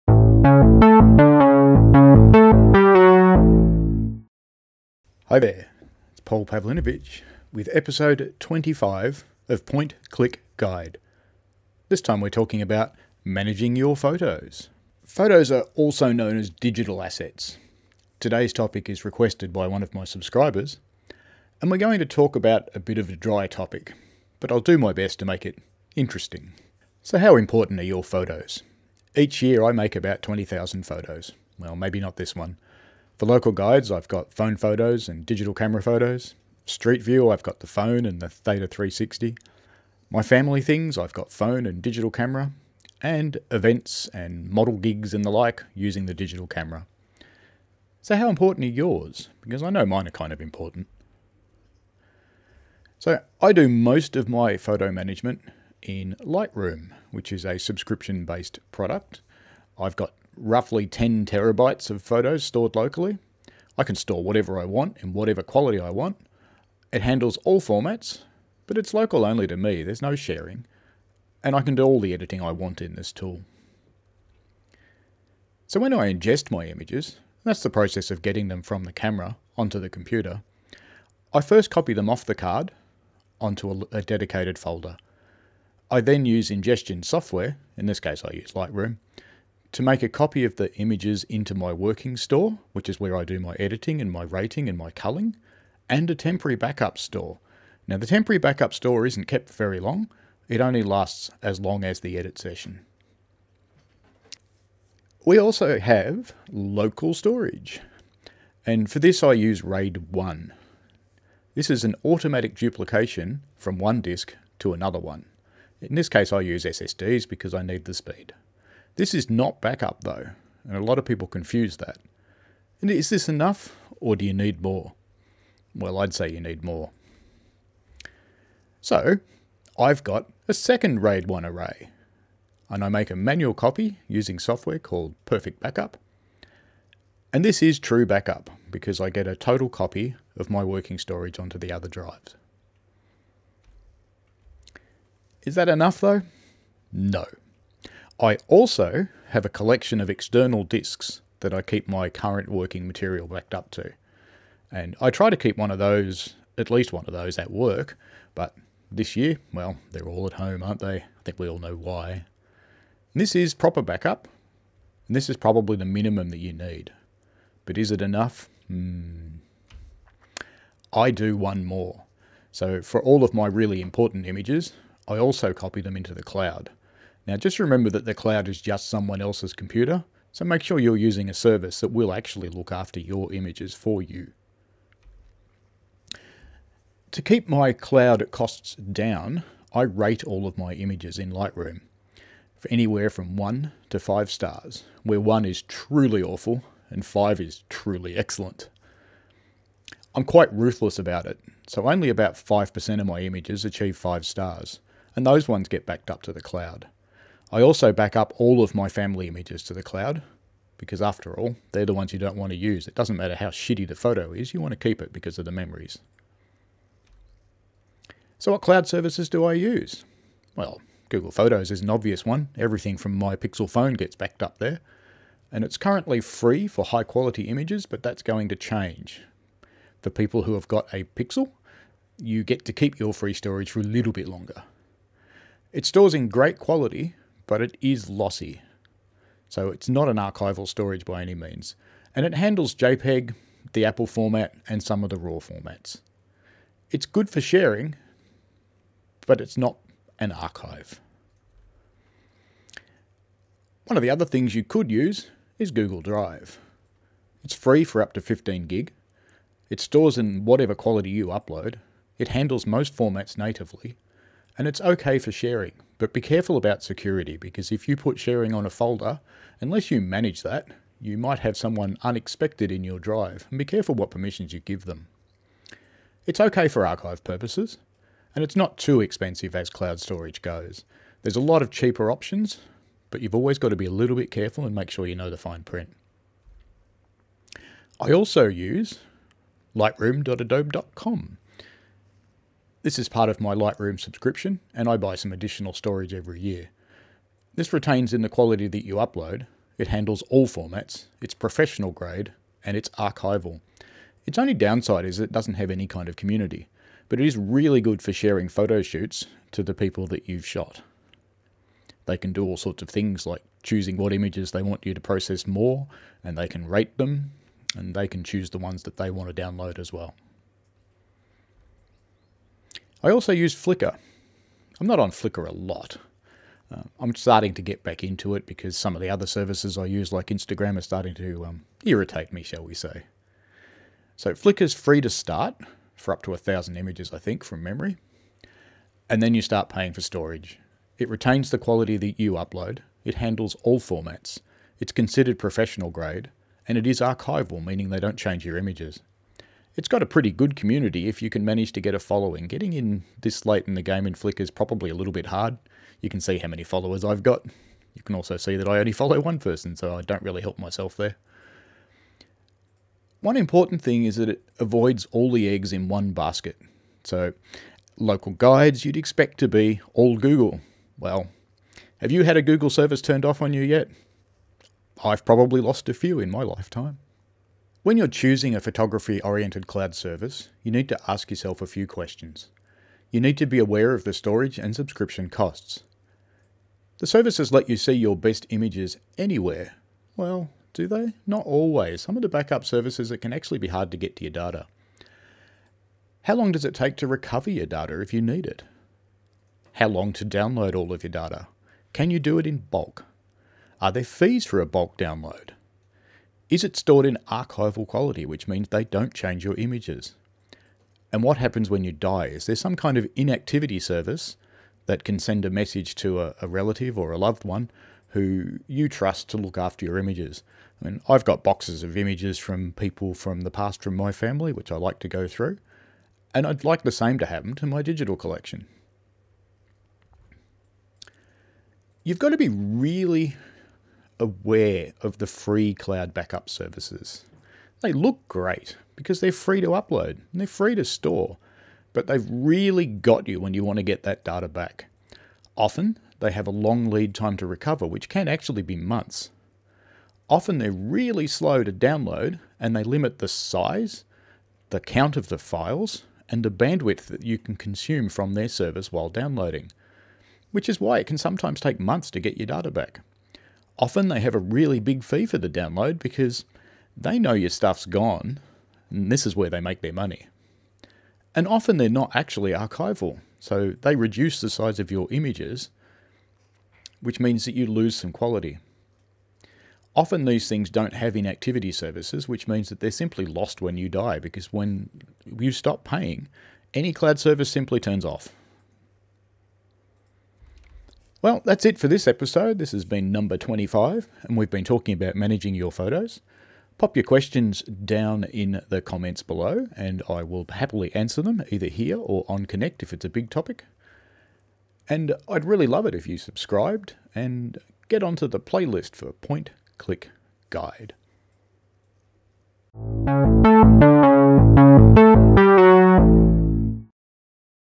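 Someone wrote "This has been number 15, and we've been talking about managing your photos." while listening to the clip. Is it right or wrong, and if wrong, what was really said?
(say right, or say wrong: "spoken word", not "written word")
wrong: "25", not "15".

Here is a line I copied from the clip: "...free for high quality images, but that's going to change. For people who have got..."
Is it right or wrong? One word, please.
right.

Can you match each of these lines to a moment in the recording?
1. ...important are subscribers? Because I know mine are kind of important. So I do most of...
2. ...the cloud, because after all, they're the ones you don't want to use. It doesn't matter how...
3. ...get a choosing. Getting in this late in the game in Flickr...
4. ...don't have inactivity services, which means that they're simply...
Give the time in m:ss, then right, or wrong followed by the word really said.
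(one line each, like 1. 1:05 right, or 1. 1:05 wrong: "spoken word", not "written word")
1. 0:48 wrong: "yours", not "subscribers"
2. 3:29 right
3. 5:51 wrong: "following", not "choosing"
4. 8:00 right.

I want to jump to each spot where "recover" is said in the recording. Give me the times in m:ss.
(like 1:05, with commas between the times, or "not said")
6:37, 7:27.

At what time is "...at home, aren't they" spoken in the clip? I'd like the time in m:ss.
2:40.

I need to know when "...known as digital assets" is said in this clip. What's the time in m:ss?
0:16.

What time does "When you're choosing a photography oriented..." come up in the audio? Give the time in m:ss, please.
6:17.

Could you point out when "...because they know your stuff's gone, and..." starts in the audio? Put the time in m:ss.
7:45.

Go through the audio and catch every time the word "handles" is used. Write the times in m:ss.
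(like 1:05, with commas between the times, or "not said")
1:07, 4:02, 4:22, 4:59, 5:43.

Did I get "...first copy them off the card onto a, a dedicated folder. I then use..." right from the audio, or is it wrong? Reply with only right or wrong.
right.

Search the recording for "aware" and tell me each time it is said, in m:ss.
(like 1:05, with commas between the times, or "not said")
6:23, 7:14.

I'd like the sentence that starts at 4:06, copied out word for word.
It's good for sharing, but it's not an archive.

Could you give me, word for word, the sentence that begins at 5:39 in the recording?
And then you start paying for storage.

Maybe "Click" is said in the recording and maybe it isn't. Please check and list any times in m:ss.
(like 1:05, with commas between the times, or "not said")
0:10, 8:29.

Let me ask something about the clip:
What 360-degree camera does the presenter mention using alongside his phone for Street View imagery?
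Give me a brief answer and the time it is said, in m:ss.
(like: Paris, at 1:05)
Theta 360, at 0:38.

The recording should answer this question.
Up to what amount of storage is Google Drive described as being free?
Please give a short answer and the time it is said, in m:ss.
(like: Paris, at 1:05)
15 gig, at 4:18.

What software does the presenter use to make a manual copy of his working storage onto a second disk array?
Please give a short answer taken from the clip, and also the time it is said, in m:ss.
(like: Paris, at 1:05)
Perfect Backup, at 2:15.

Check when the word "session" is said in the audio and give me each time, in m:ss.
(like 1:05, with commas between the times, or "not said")
1:42.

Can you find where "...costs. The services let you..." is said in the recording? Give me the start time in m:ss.
6:25.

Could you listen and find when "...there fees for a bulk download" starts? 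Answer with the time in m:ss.
6:43.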